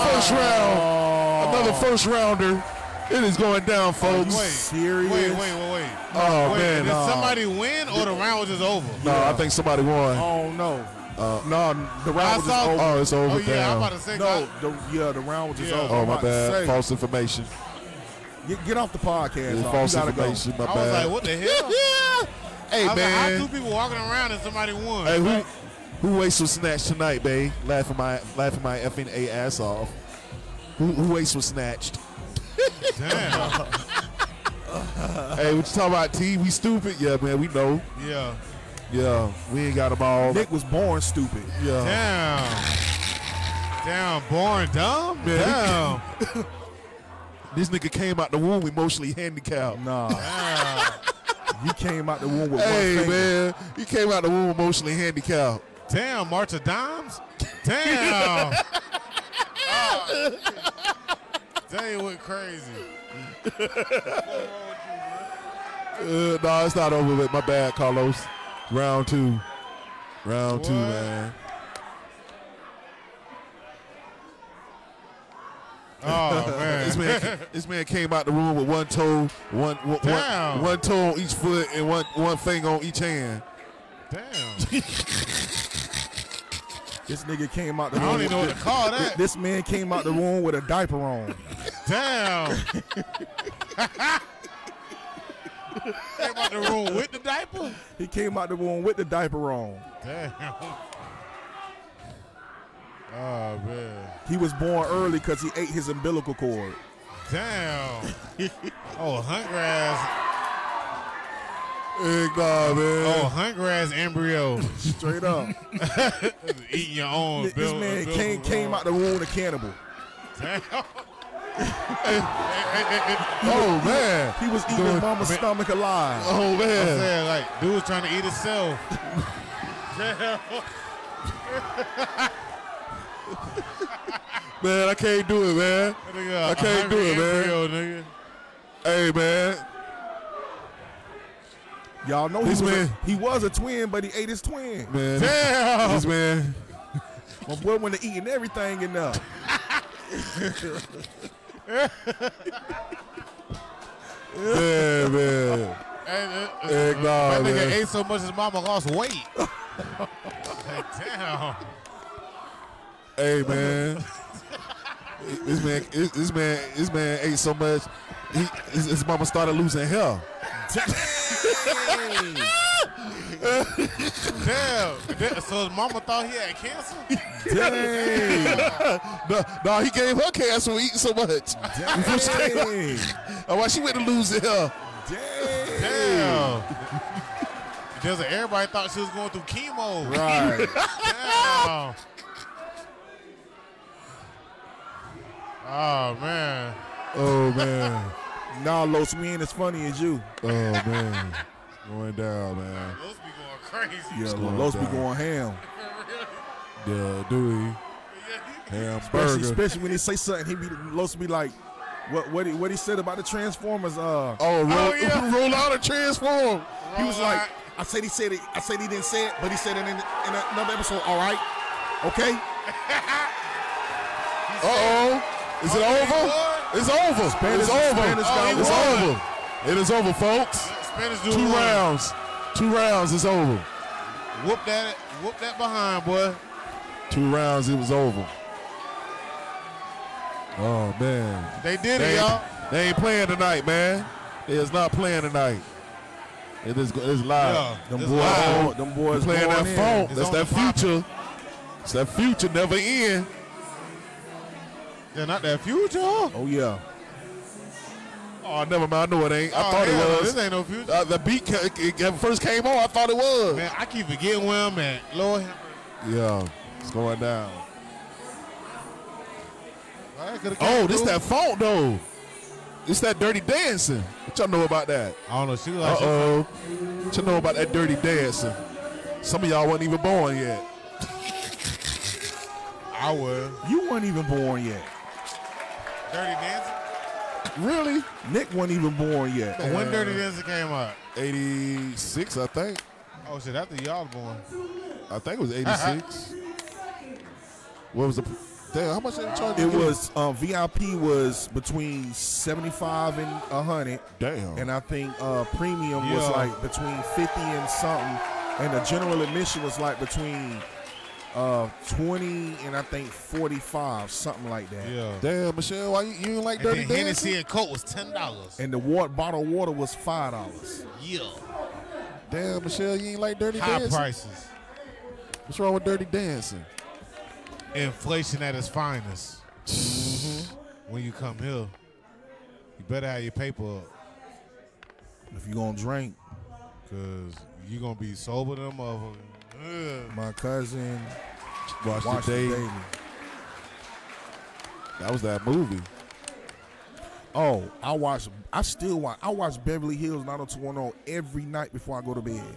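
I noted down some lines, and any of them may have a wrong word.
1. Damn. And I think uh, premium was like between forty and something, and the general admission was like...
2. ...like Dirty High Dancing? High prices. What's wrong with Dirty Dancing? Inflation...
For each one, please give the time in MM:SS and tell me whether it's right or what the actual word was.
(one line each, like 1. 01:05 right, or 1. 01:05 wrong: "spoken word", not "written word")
1. 05:04 wrong: "fifty", not "forty"
2. 05:23 right.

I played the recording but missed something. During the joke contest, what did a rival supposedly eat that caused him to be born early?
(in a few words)
umbilical cord.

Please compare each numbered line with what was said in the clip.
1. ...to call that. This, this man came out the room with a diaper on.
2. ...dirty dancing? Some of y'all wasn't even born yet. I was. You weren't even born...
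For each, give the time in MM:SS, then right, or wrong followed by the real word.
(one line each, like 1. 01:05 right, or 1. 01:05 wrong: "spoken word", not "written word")
1. 01:28 right
2. 04:37 right.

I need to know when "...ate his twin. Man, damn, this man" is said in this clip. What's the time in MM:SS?
02:24.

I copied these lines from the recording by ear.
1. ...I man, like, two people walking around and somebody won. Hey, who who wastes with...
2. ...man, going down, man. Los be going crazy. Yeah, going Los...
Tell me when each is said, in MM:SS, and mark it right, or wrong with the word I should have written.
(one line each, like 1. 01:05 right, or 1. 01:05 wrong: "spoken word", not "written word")
1. 00:22 right
2. 03:20 right.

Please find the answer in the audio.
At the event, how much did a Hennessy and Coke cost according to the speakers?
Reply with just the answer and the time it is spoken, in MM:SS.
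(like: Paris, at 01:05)
$10, at 05:17.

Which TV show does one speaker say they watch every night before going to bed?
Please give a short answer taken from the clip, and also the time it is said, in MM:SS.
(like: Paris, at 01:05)
Beverly Hills 90210, at 05:49.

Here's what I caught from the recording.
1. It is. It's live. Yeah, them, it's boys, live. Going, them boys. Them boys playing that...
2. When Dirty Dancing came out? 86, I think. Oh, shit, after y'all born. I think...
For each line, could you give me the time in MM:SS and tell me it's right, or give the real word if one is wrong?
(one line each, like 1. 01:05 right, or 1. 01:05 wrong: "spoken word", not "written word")
1. 04:06 right
2. 04:49 right.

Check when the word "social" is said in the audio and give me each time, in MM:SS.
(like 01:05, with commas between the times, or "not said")
not said.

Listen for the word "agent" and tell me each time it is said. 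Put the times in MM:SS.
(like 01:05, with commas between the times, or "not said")
not said.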